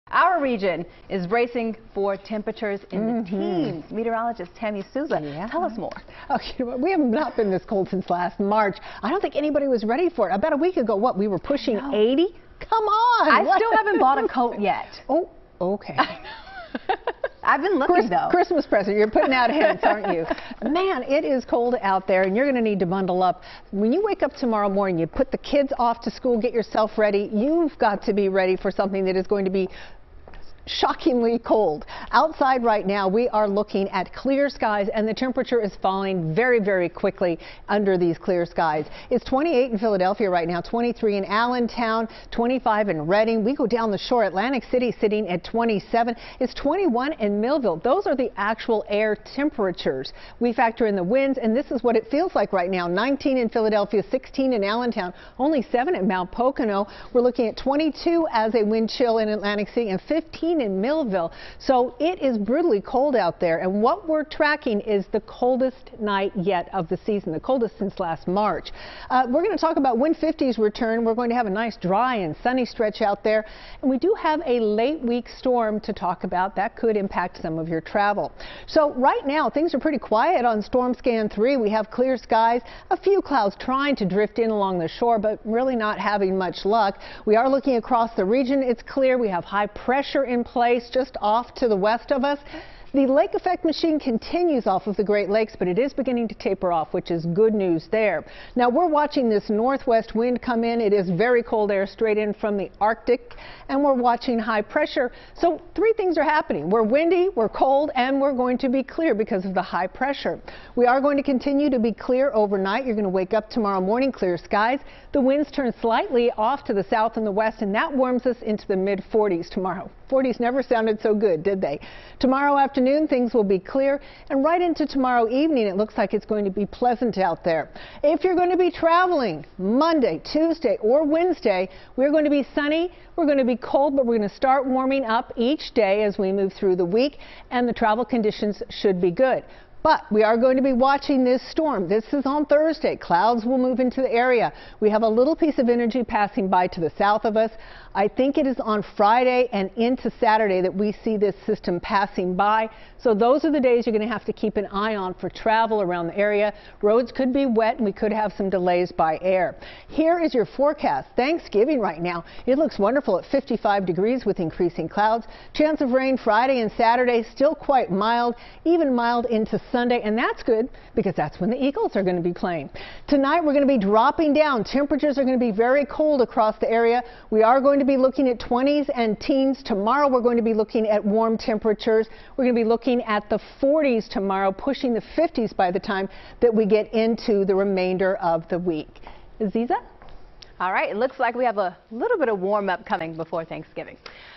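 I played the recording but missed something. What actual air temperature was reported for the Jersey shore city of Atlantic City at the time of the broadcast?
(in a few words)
27.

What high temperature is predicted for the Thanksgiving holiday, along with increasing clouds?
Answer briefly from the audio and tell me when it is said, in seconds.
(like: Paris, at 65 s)
55 degrees, at 163 s.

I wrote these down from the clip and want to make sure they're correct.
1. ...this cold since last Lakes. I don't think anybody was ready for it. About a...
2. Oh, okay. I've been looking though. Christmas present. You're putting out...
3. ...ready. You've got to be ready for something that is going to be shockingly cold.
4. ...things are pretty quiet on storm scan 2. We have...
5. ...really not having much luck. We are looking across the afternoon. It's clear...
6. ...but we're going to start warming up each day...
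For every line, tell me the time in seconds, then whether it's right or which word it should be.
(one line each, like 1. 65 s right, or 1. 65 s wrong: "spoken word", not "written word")
1. 7 s wrong: "March", not "Lakes"
2. 15 s right
3. 27 s right
4. 79 s wrong: "3", not "2"
5. 85 s wrong: "region", not "afternoon"
6. 133 s right.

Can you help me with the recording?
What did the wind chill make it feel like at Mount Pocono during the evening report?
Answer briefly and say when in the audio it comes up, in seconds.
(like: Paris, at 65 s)
7, at 55 s.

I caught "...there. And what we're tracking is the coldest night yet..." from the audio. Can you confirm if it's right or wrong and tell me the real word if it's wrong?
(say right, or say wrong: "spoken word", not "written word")
right.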